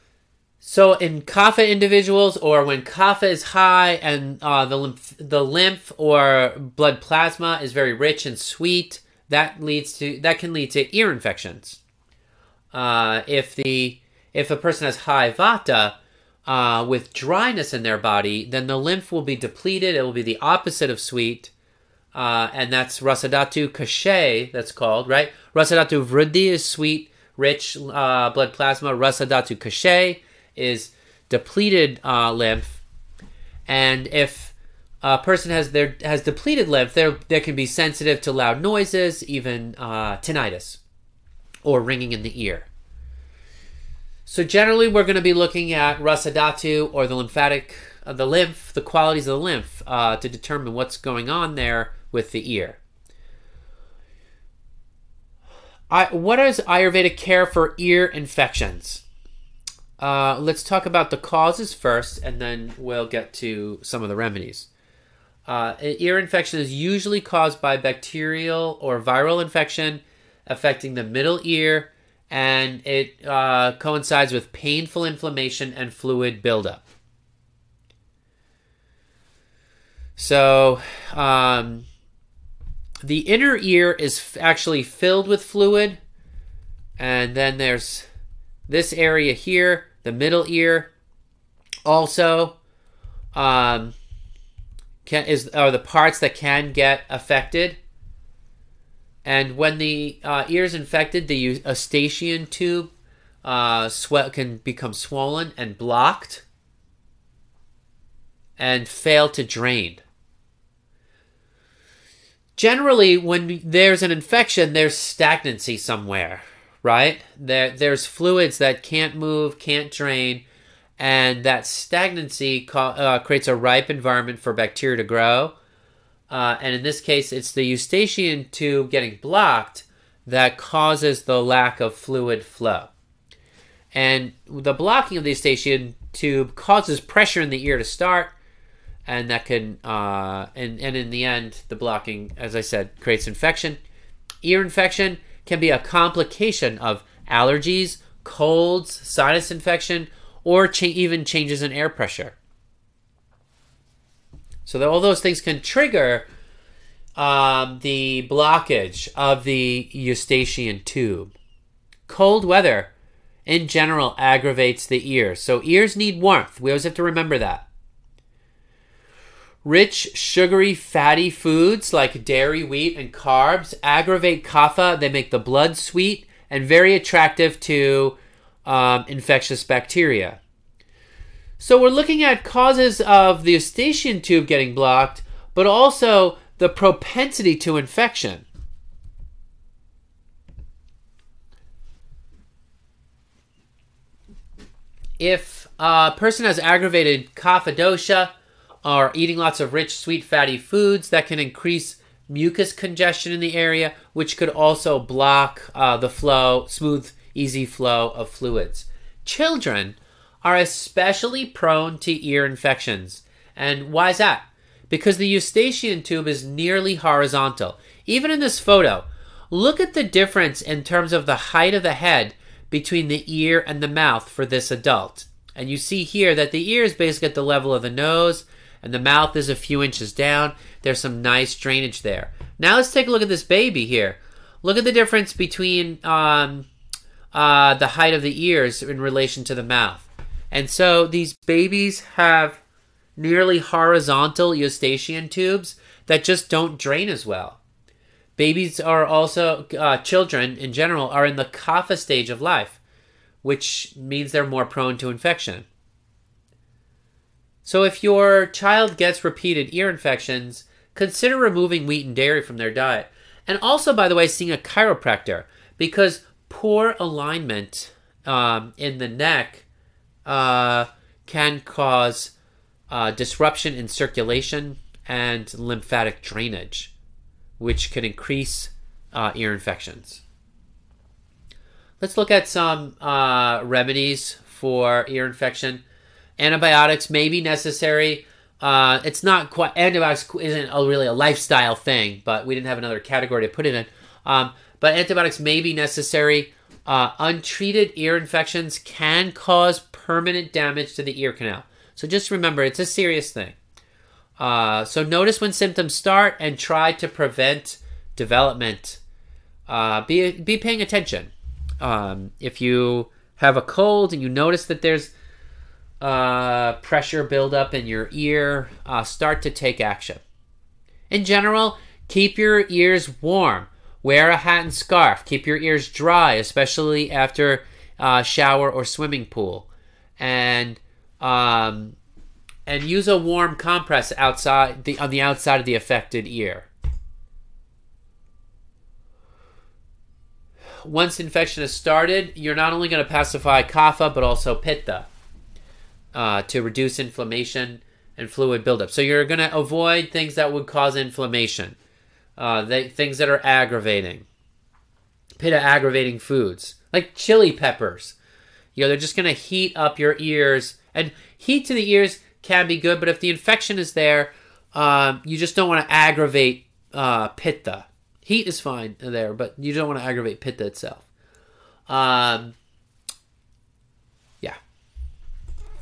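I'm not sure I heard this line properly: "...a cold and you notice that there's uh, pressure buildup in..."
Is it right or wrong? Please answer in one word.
right.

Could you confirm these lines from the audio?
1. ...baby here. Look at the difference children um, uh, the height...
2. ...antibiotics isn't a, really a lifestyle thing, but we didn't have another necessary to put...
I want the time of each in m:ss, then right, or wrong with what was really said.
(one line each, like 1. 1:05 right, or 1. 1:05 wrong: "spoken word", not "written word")
1. 3:53 wrong: "between", not "children"
2. 4:49 wrong: "category", not "necessary".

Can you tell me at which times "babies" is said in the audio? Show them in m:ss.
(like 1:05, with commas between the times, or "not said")
4:01, 4:08.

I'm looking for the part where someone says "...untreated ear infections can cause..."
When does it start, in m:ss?
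4:57.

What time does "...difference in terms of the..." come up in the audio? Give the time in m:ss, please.
3:40.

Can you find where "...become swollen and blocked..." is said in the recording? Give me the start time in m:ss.
1:44.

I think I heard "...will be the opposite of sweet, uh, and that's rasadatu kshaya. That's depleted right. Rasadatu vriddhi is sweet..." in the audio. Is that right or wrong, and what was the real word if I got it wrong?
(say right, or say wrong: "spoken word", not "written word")
wrong: "called", not "depleted".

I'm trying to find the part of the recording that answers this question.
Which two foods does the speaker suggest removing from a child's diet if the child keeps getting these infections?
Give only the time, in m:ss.
4:21.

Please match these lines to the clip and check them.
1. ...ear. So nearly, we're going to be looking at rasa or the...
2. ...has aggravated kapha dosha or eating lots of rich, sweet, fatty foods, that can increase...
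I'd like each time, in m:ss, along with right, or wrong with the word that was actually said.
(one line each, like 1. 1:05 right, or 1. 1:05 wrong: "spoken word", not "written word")
1. 0:42 wrong: "generally", not "nearly"
2. 3:16 right.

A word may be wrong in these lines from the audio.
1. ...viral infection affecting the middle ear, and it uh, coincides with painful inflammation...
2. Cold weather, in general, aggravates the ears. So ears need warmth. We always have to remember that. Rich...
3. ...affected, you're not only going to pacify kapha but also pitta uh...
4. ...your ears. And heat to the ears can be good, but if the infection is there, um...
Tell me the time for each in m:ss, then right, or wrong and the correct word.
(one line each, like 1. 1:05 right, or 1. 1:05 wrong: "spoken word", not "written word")
1. 1:09 right
2. 2:42 right
3. 5:41 wrong: "started", not "affected"
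4. 5:59 right.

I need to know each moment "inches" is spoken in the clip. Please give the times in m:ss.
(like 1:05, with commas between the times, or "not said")
3:49.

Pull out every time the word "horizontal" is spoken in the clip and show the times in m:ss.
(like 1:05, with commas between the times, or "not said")
3:36, 4:03.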